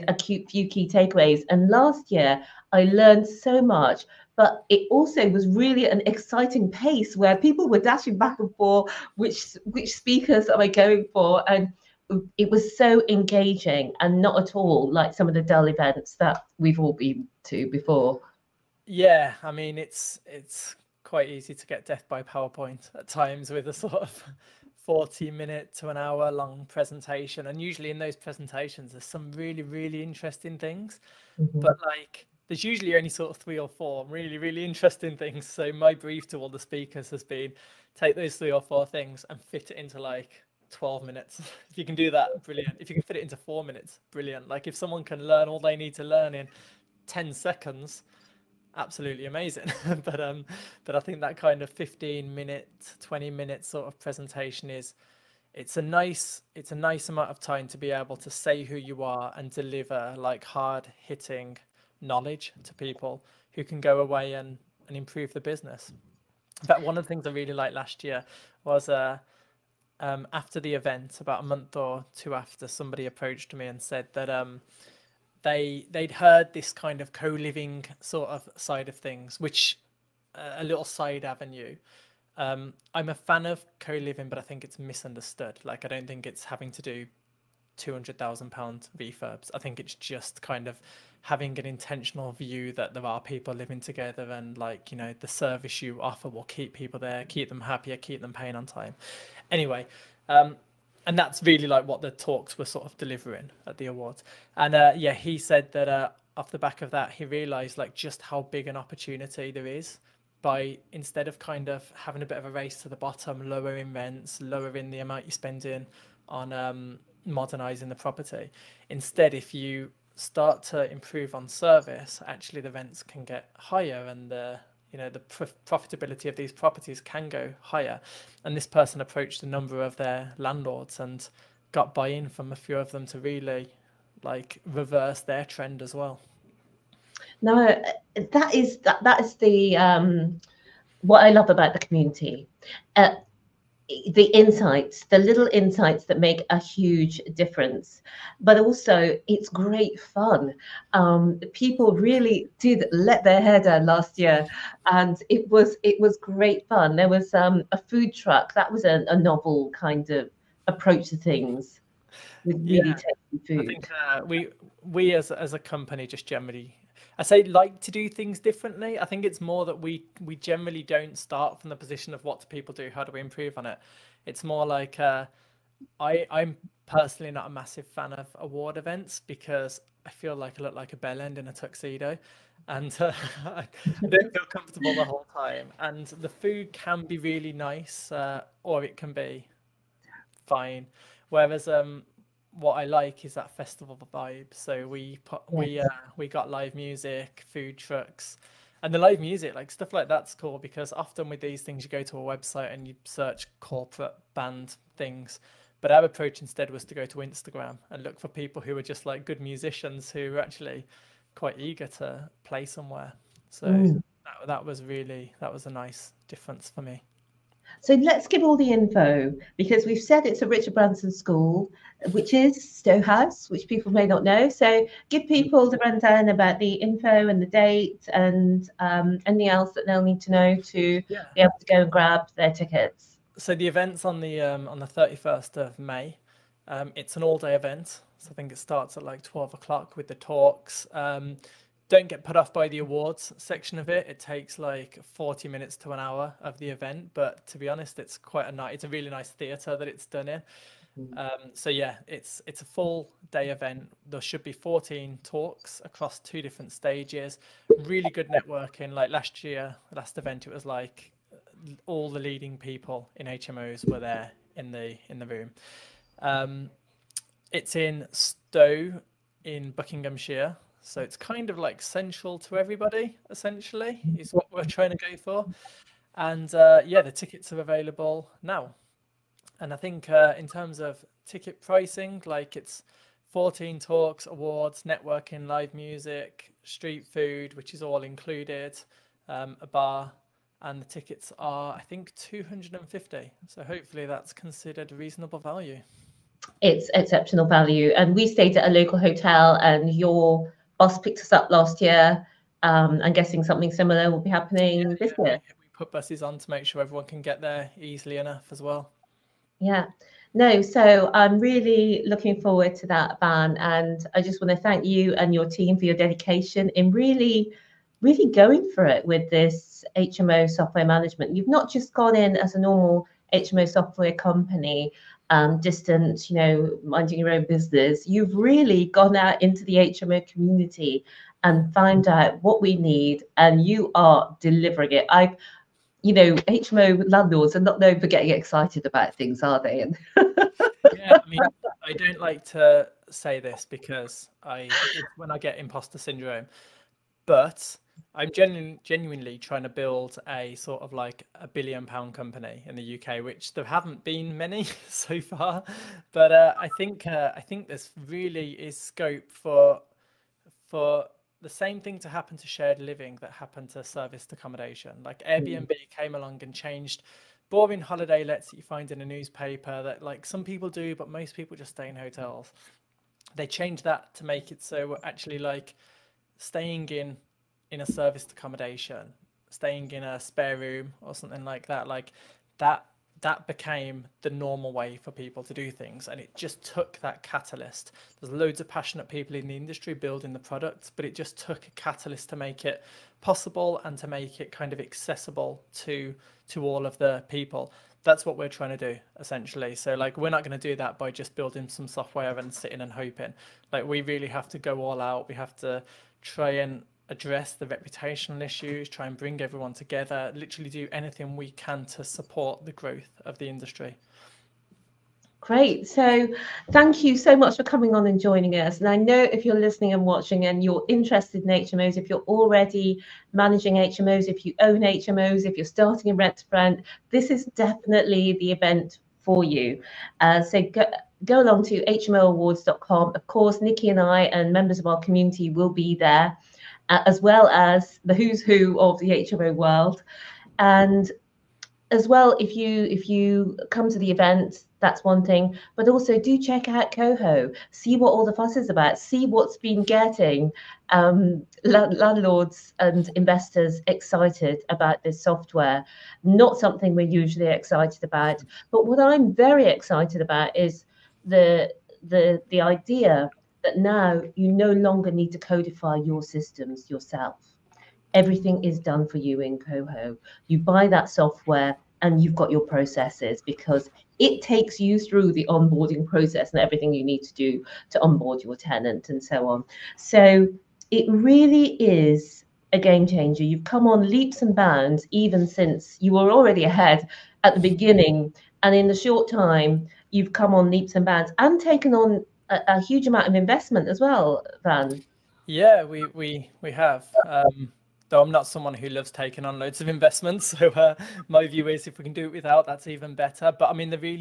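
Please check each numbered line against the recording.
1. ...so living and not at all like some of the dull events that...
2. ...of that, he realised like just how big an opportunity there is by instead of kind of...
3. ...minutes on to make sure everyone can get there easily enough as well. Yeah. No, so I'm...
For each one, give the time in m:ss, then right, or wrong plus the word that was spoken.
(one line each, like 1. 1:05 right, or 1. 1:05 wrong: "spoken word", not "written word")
1. 0:12 wrong: "engaging", not "living"
2. 1:46 right
3. 5:05 wrong: "buses", not "minutes".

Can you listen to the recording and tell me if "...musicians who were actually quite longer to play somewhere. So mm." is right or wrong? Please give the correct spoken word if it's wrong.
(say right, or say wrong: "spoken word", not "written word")
wrong: "eager", not "longer".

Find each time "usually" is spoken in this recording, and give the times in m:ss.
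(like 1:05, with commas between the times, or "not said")
0:27, 0:32, 7:37.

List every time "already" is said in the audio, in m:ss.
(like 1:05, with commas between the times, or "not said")
7:02, 8:06.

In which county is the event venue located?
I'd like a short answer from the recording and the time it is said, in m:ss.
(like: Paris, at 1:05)
Buckinghamshire, at 4:29.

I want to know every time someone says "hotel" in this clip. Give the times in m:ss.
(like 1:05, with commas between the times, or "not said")
4:58, 6:11.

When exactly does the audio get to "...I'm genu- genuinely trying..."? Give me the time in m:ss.
5:48.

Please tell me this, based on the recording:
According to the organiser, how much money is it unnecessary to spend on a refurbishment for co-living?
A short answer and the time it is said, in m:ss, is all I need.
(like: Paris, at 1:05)
£200,000, at 1:27.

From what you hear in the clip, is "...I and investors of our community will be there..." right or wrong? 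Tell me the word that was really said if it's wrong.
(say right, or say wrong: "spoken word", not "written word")
wrong: "members", not "investors".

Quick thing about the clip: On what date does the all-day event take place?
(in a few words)
31st of May.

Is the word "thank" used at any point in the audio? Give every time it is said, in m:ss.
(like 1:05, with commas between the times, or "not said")
5:14, 6:56.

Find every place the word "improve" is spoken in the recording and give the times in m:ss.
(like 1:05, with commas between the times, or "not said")
1:04, 2:00, 2:53.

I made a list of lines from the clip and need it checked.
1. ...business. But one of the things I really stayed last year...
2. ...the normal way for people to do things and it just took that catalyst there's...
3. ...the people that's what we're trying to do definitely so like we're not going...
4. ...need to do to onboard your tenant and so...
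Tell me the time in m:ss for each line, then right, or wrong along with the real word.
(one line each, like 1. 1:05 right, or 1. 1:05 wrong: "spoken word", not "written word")
1. 1:05 wrong: "liked", not "stayed"
2. 6:24 right
3. 6:36 wrong: "essentially", not "definitely"
4. 7:57 right.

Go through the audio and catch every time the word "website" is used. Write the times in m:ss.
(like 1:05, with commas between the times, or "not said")
3:22.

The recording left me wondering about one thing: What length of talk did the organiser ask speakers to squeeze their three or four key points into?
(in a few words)
12 minutes.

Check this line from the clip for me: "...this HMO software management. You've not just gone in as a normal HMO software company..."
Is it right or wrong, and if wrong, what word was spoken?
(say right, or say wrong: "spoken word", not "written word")
right.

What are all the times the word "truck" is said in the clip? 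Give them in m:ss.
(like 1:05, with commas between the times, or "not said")
2:38, 3:17.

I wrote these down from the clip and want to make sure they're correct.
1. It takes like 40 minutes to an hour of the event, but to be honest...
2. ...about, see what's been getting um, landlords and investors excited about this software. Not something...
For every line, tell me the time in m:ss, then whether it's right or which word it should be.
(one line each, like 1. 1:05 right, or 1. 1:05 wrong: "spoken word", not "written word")
1. 4:04 right
2. 7:28 right.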